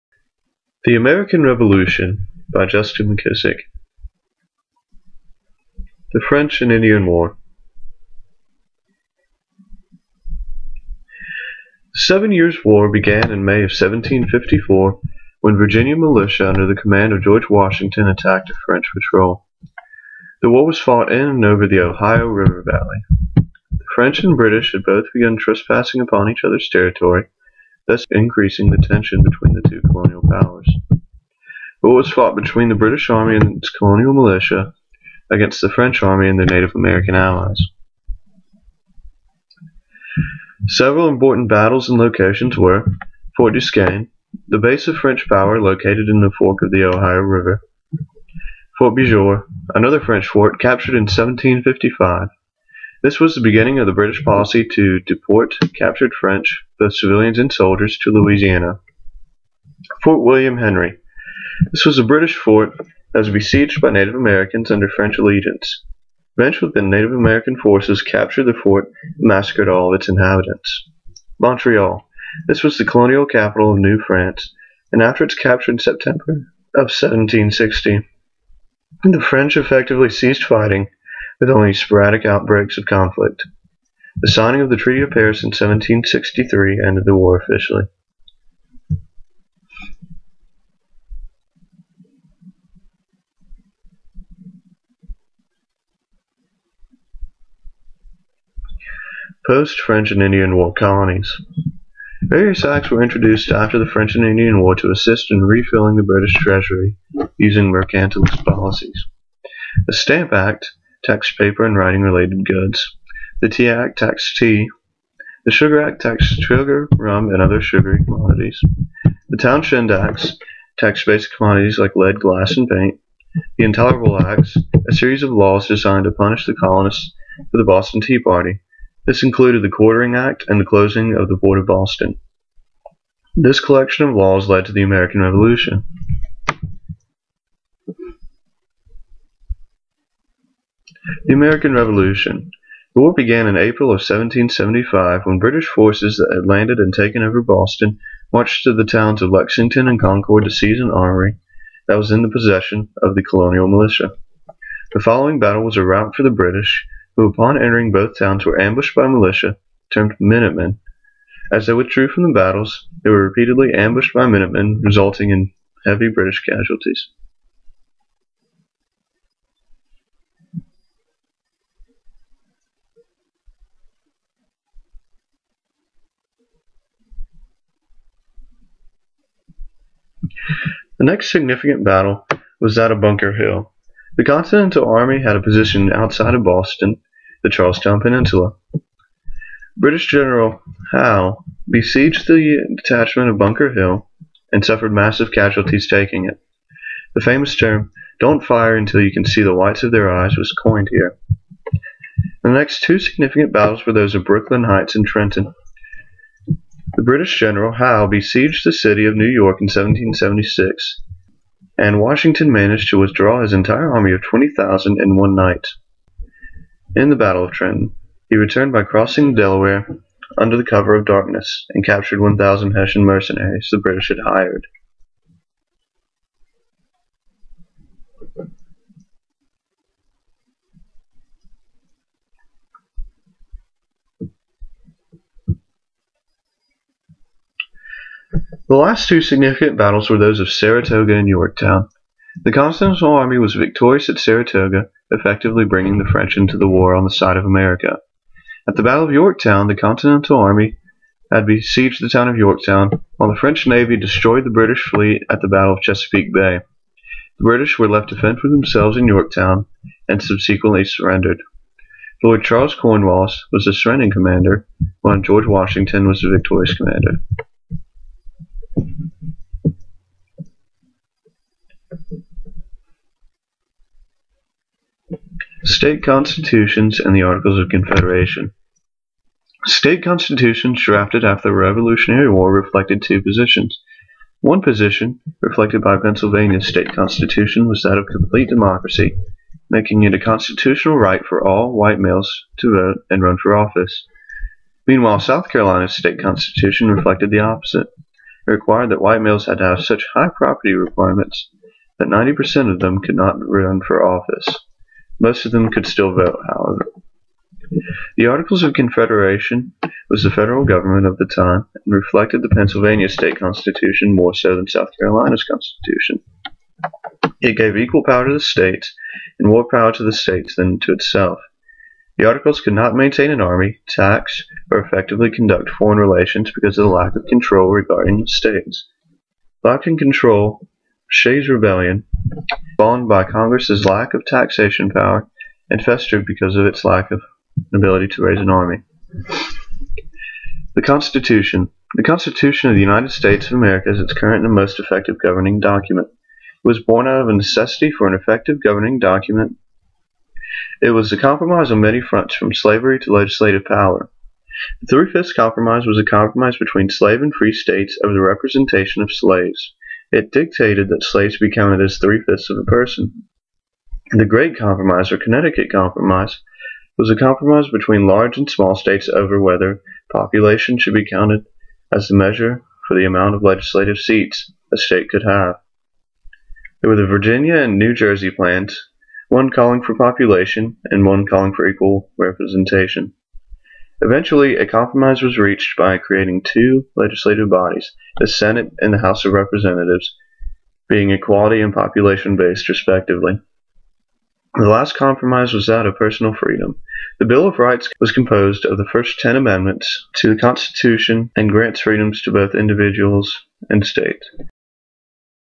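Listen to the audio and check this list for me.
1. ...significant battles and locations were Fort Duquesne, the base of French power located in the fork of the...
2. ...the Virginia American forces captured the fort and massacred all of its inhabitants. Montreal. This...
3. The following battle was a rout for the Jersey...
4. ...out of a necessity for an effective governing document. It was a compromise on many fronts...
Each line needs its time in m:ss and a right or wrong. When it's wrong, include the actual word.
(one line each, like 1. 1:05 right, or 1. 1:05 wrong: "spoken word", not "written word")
1. 0:41 wrong: "important", not "significant"
2. 1:06 wrong: "Native", not "Virginia"
3. 2:34 wrong: "British", not "Jersey"
4. 5:47 right.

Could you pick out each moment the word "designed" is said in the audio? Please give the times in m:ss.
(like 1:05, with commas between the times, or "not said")
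2:05.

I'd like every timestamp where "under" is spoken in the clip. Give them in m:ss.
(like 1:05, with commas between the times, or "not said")
0:16, 1:04, 3:40.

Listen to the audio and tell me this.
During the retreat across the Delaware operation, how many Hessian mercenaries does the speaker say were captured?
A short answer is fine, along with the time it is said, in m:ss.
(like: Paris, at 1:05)
1,000, at 3:42.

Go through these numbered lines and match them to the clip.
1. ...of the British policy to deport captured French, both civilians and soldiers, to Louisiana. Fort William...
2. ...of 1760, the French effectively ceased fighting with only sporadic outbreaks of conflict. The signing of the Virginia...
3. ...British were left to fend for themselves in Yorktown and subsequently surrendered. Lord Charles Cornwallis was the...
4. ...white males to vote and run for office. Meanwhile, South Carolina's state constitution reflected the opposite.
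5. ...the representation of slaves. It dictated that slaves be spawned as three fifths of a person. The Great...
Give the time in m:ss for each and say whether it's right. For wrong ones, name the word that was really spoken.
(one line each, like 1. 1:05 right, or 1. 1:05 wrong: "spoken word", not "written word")
1. 0:53 right
2. 1:16 wrong: "Treaty", not "Virginia"
3. 4:17 right
4. 4:51 right
5. 5:58 wrong: "counted", not "spawned".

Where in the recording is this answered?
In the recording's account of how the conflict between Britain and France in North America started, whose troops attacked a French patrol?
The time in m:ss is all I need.
0:15.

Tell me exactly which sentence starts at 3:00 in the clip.
The next significant battle was that of Bunker Hill.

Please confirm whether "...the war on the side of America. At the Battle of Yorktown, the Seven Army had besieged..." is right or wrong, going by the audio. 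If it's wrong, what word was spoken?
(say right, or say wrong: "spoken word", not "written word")
wrong: "Continental", not "Seven".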